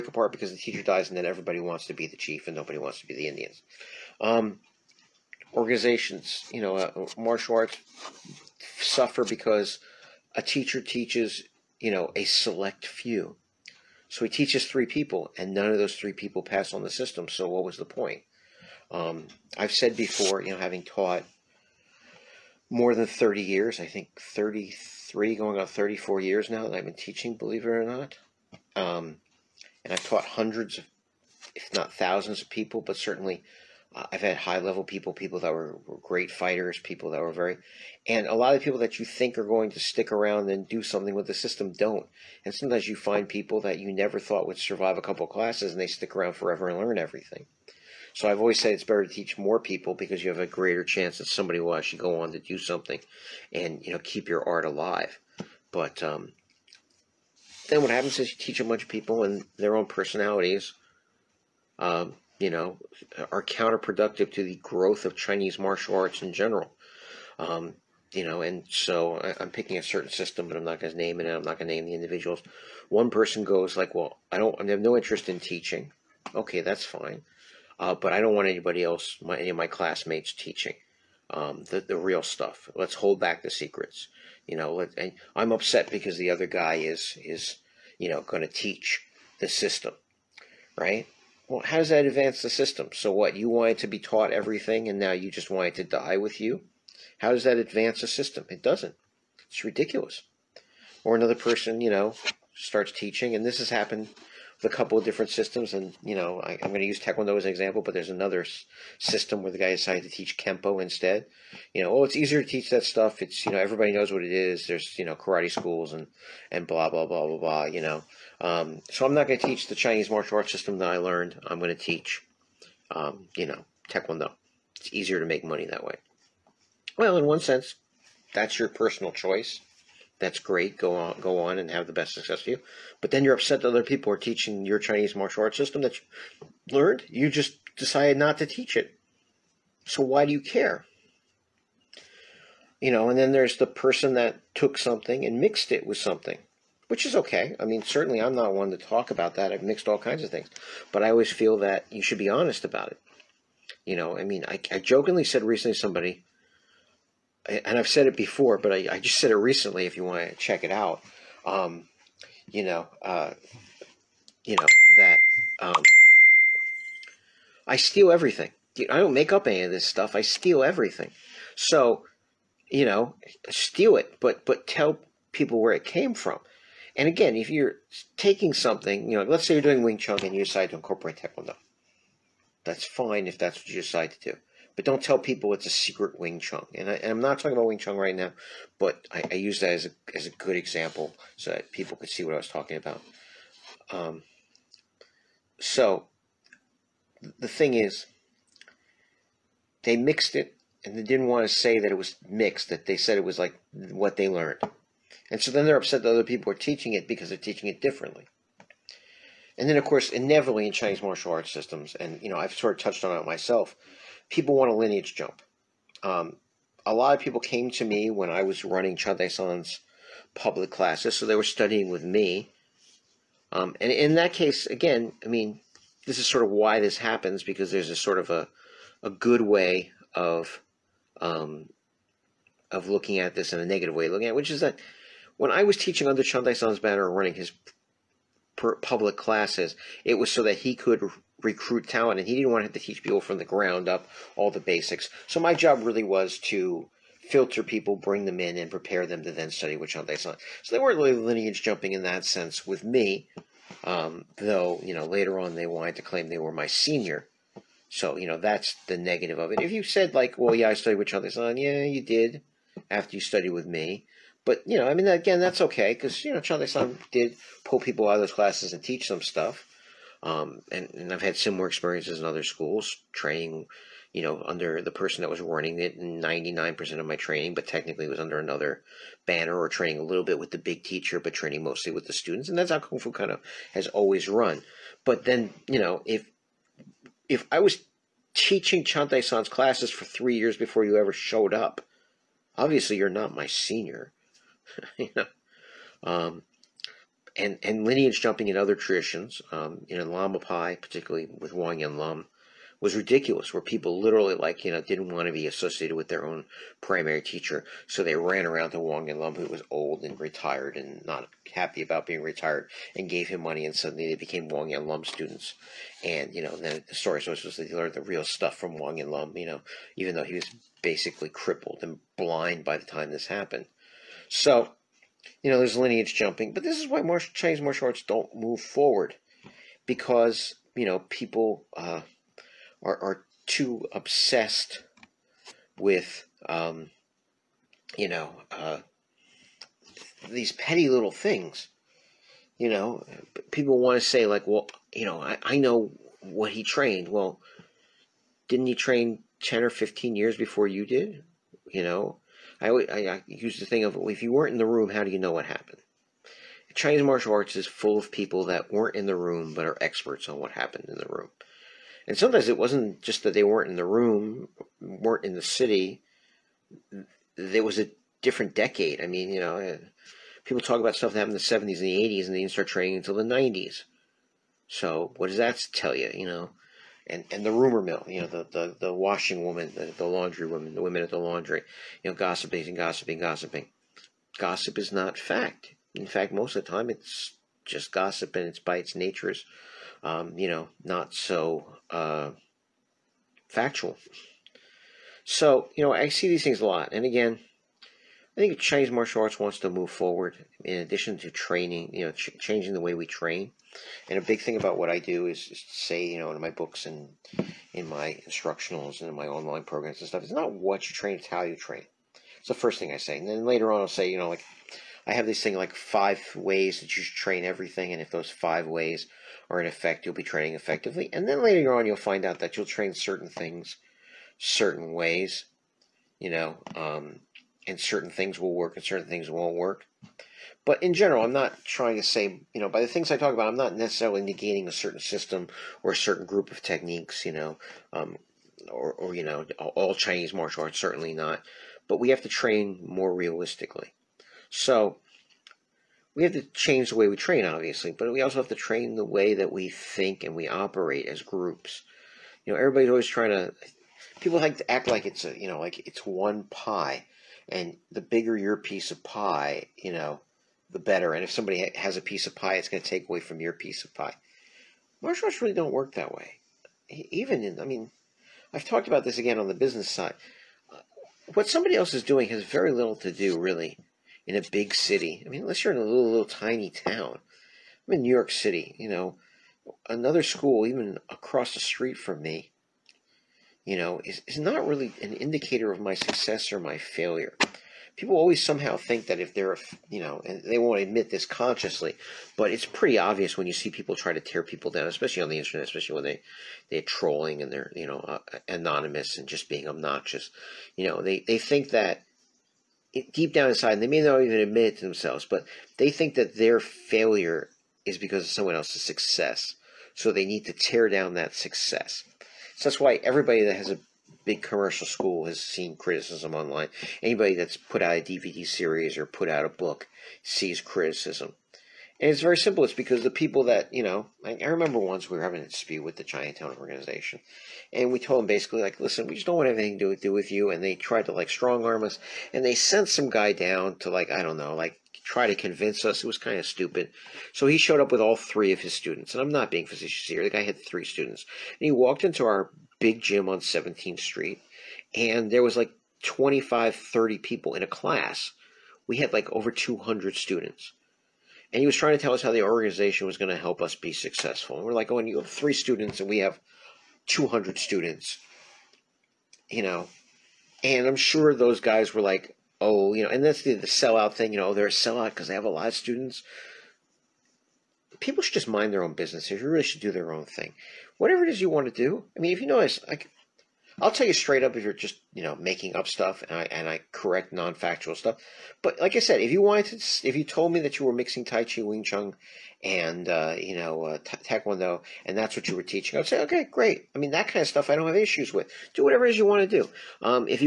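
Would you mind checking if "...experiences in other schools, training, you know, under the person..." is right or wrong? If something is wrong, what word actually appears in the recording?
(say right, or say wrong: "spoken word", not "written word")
right.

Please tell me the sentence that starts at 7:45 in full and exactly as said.
Martial arts really don't work that way.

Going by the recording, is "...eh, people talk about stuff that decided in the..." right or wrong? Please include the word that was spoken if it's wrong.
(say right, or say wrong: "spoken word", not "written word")
wrong: "happened", not "decided".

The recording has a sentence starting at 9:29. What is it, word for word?
You really should do their own thing.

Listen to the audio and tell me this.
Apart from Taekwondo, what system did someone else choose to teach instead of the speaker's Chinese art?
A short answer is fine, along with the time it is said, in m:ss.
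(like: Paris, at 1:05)
Kempo, at 1:50.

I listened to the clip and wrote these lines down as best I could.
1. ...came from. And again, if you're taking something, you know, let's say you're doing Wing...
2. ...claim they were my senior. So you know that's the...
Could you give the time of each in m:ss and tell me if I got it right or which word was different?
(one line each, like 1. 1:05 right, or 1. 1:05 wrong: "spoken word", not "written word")
1. 2:55 right
2. 4:16 right.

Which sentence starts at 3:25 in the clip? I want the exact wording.
And so then they're upset that other people are teaching it because they're teaching it differently.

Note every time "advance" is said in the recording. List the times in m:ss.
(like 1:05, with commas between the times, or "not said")
1:32, 1:37.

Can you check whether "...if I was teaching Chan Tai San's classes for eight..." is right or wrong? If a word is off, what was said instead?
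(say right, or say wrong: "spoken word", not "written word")
wrong: "three", not "eight".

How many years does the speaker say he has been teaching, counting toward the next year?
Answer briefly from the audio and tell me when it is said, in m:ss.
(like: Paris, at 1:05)
33, at 0:23.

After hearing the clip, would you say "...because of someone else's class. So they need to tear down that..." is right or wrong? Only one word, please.
wrong.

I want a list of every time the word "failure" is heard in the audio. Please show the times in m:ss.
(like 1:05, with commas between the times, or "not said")
8:06, 8:26.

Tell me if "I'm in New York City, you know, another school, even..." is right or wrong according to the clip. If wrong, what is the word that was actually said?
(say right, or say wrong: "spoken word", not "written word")
right.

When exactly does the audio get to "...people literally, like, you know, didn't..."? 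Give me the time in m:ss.
5:03.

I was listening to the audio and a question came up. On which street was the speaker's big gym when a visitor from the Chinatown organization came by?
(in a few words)
17th Street.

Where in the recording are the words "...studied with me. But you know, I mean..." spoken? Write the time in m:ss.
4:23.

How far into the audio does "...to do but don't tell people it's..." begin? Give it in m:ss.
3:04.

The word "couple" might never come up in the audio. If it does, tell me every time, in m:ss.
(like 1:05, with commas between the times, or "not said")
0:45, 1:44.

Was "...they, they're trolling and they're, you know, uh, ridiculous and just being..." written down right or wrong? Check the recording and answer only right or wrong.
wrong.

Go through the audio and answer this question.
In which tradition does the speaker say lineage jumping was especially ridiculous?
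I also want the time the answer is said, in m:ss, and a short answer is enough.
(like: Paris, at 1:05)
Lamapai, at 4:59.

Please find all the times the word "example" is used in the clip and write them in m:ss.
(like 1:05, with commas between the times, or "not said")
1:47, 3:10.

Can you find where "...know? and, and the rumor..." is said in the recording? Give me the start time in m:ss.
6:16.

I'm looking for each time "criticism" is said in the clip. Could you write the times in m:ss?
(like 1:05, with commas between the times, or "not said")
8:35, 8:40.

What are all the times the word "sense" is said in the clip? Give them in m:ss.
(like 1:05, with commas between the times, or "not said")
2:07, 4:12.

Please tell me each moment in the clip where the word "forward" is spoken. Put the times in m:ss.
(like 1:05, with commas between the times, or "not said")
5:28, 6:39.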